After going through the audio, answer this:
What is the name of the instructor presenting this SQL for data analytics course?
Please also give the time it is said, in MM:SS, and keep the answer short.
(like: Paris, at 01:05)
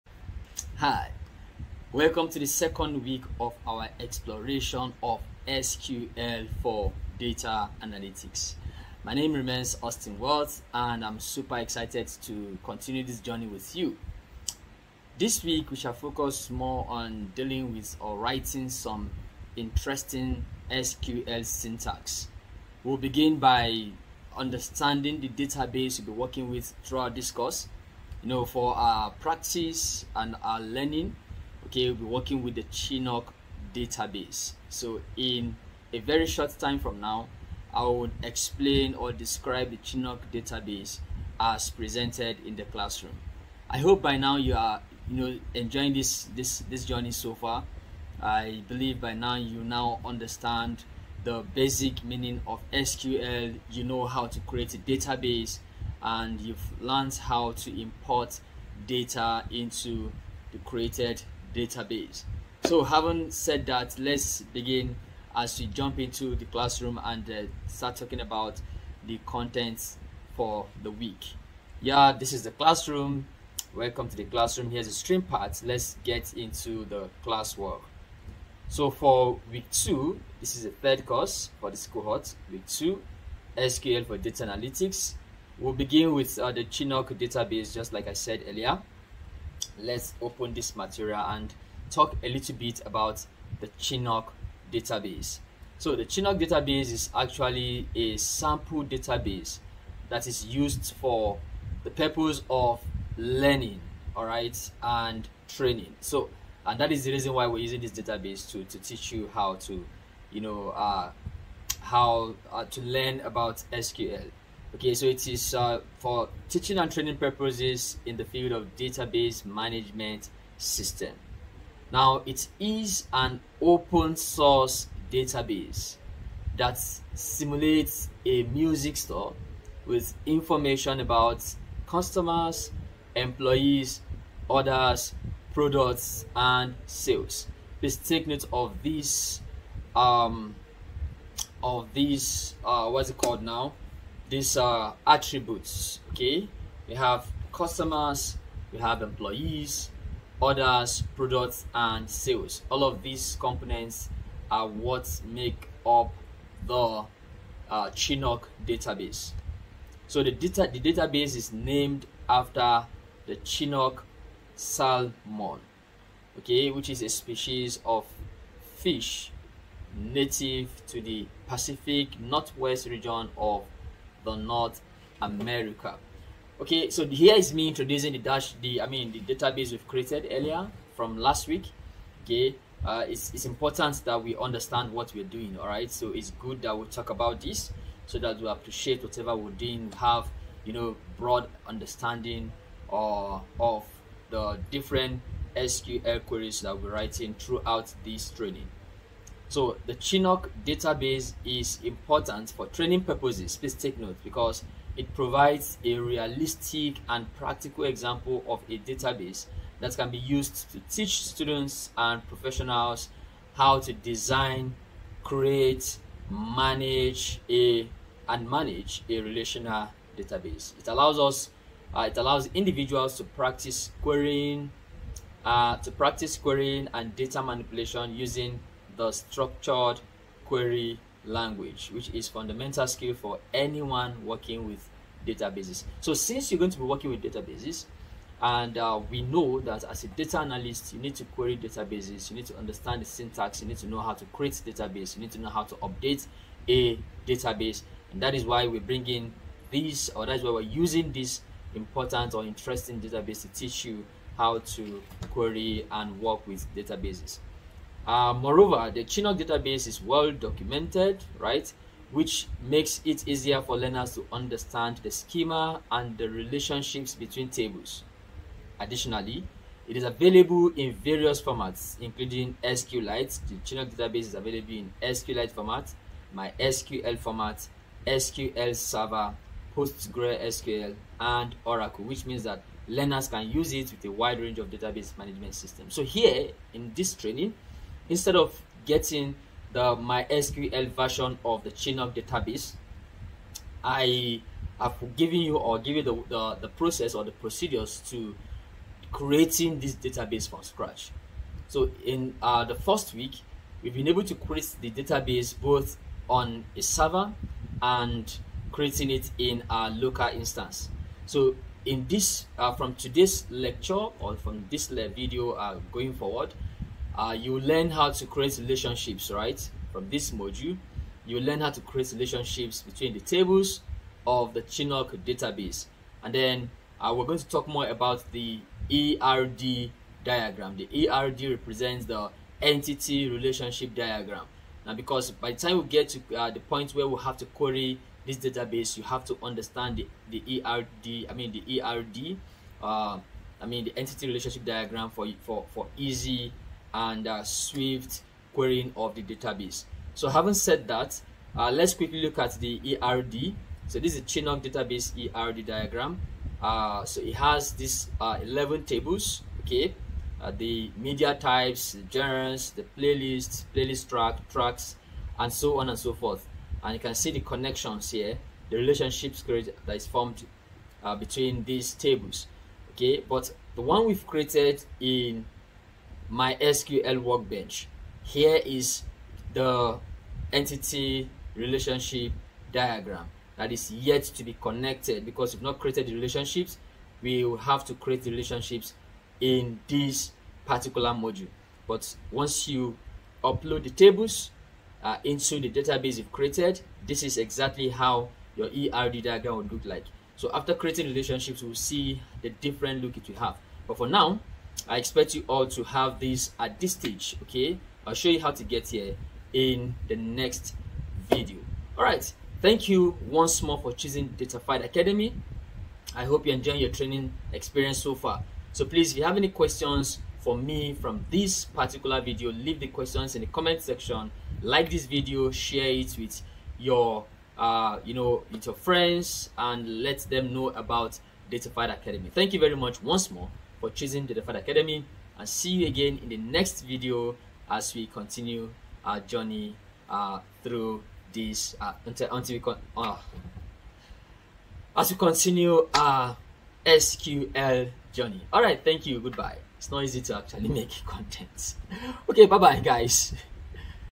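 Austin Watts, at 00:09.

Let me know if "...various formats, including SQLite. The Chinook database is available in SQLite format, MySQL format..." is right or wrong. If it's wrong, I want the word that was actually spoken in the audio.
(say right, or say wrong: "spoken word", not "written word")
right.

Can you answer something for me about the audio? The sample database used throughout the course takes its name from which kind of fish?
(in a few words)
Chinook salmon.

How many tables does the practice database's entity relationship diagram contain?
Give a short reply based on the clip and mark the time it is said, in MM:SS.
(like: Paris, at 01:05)
11, at 05:58.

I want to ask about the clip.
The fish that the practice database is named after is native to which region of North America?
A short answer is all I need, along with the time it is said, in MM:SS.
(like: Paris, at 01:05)
Pacific Northwest, at 02:51.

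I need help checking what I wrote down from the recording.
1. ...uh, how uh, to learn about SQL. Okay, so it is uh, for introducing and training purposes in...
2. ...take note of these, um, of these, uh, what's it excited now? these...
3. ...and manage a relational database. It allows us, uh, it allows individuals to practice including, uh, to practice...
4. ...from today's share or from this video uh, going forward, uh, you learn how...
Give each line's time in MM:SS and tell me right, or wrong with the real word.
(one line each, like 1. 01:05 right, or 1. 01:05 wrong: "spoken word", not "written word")
1. 01:50 wrong: "teaching", not "introducing"
2. 02:17 wrong: "called", not "excited"
3. 03:38 wrong: "querying", not "including"
4. 05:12 wrong: "lecture", not "share".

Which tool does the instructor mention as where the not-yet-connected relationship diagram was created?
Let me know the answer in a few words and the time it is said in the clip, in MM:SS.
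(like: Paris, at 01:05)
MySQL workbench, at 06:16.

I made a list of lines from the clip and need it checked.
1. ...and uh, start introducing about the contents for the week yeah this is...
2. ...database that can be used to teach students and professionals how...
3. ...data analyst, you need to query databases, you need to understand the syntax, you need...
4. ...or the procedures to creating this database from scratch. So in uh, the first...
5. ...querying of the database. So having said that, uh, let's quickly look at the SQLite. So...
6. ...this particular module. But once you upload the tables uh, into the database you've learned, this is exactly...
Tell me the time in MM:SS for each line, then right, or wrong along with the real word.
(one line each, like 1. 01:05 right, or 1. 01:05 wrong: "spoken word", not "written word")
1. 01:07 wrong: "talking", not "introducing"
2. 03:28 right
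3. 04:00 right
4. 04:57 right
5. 05:48 wrong: "ERD", not "SQLite"
6. 06:29 wrong: "created", not "learned".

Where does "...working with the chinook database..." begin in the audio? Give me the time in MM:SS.
00:32.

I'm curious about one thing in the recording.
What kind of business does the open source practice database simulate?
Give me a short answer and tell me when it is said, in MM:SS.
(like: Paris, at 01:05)
A music store, at 02:08.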